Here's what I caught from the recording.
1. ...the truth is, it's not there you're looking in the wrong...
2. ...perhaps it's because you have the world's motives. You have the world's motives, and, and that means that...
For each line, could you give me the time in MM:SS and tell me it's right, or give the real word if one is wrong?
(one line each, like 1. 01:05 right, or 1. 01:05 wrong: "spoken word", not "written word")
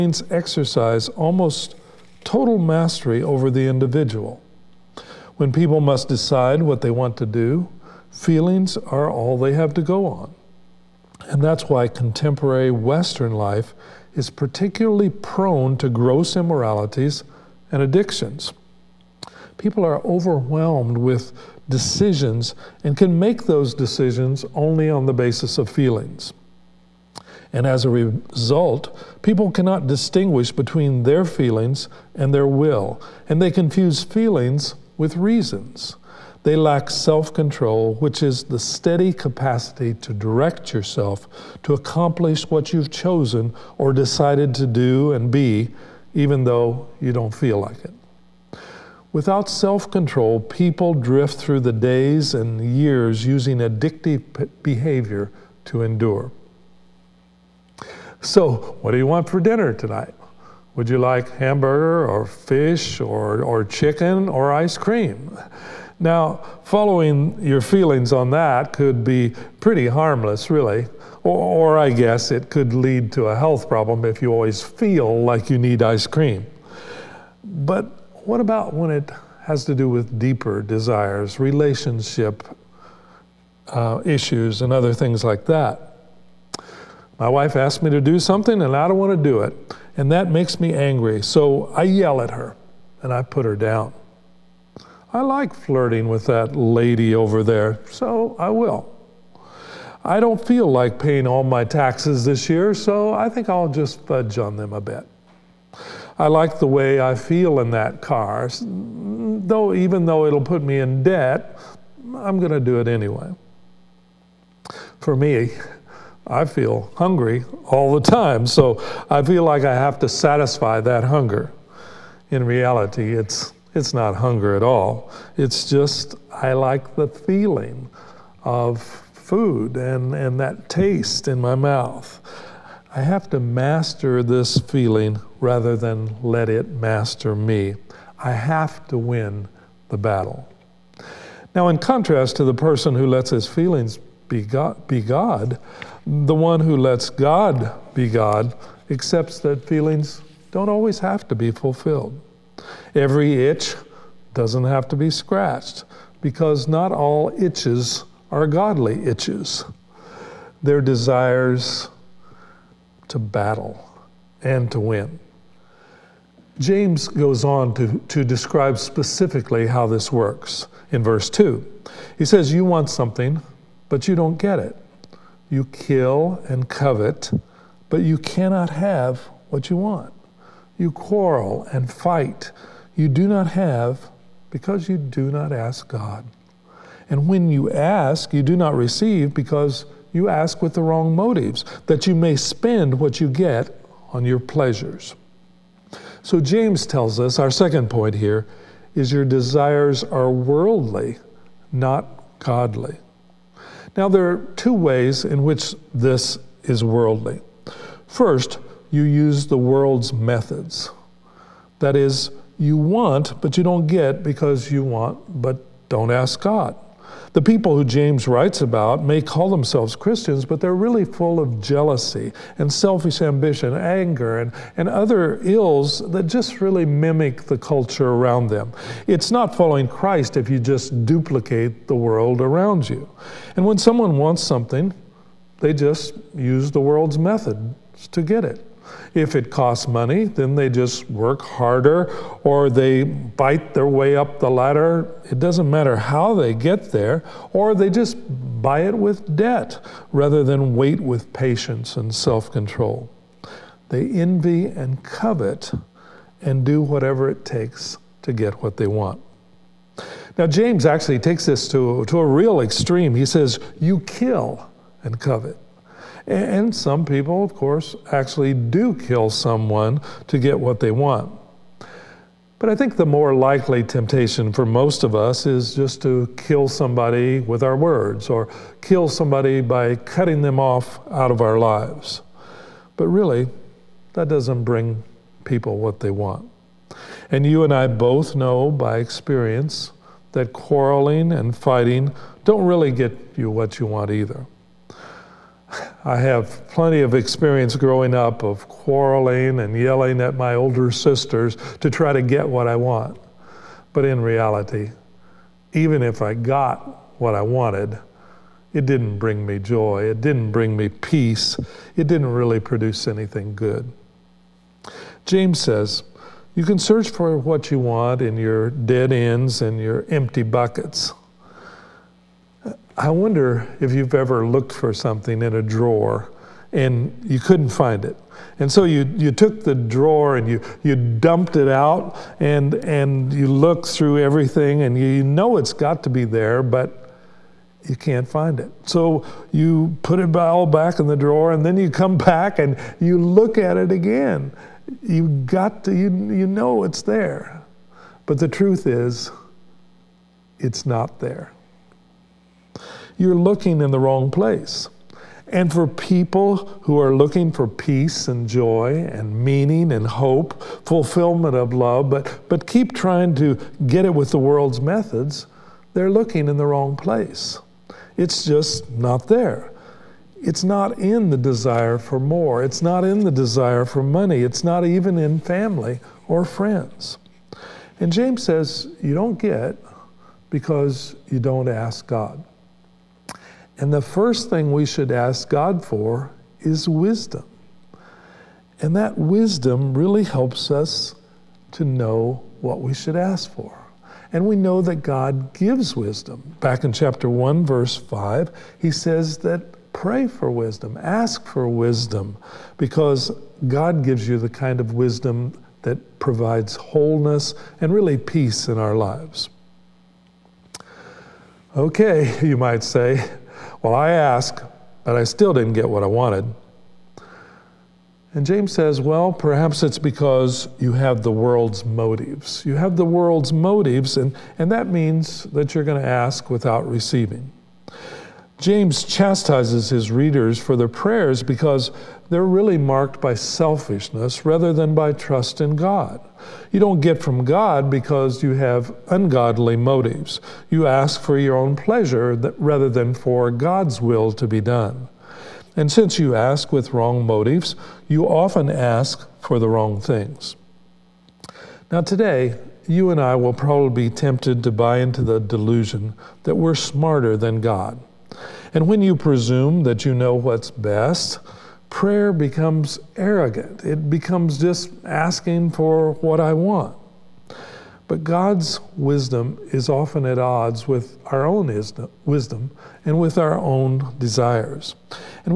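1. 05:48 right
2. 06:59 right.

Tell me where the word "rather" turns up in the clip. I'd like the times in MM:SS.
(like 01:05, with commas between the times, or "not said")
02:15, 04:10, 07:14, 07:22.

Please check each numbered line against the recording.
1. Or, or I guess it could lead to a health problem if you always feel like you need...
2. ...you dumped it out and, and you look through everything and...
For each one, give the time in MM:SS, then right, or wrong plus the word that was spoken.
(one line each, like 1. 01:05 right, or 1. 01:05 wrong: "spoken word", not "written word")
1. 01:11 right
2. 05:30 right.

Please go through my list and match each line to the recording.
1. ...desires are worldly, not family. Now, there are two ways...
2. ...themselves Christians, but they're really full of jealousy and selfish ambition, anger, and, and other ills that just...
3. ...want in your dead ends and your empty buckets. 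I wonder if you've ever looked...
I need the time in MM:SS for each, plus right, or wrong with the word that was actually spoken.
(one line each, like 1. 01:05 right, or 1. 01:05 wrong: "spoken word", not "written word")
1. 03:19 wrong: "godly", not "family"
2. 03:39 right
3. 05:17 right.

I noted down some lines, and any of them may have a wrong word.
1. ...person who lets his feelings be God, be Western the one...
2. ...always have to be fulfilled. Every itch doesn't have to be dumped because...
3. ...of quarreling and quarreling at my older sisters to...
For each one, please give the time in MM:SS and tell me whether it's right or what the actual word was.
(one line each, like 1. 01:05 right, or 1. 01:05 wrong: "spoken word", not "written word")
1. 02:22 wrong: "God", not "Western"
2. 02:30 wrong: "scratched", not "dumped"
3. 04:58 wrong: "yelling", not "quarreling".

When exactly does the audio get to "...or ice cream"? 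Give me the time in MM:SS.
01:04.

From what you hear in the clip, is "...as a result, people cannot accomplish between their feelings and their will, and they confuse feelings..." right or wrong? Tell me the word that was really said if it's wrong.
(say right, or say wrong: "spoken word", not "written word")
wrong: "distinguish", not "accomplish".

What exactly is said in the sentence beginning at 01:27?
My wife asked me to do something, and I don't want to do it.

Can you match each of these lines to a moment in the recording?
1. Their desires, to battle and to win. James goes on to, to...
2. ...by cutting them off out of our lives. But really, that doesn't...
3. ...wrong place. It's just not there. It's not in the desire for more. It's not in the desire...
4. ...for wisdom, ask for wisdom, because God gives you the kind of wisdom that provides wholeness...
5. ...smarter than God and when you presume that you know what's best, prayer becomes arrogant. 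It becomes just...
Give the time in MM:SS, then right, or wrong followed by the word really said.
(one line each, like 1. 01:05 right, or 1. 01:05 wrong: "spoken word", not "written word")
1. 02:40 right
2. 04:39 right
3. 06:06 right
4. 06:40 right
5. 07:36 right.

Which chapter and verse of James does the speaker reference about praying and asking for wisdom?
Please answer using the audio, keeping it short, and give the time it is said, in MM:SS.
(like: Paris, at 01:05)
Chapter 1, verse 5, at 06:36.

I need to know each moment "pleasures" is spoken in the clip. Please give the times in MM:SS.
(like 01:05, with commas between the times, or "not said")
03:14, 07:21.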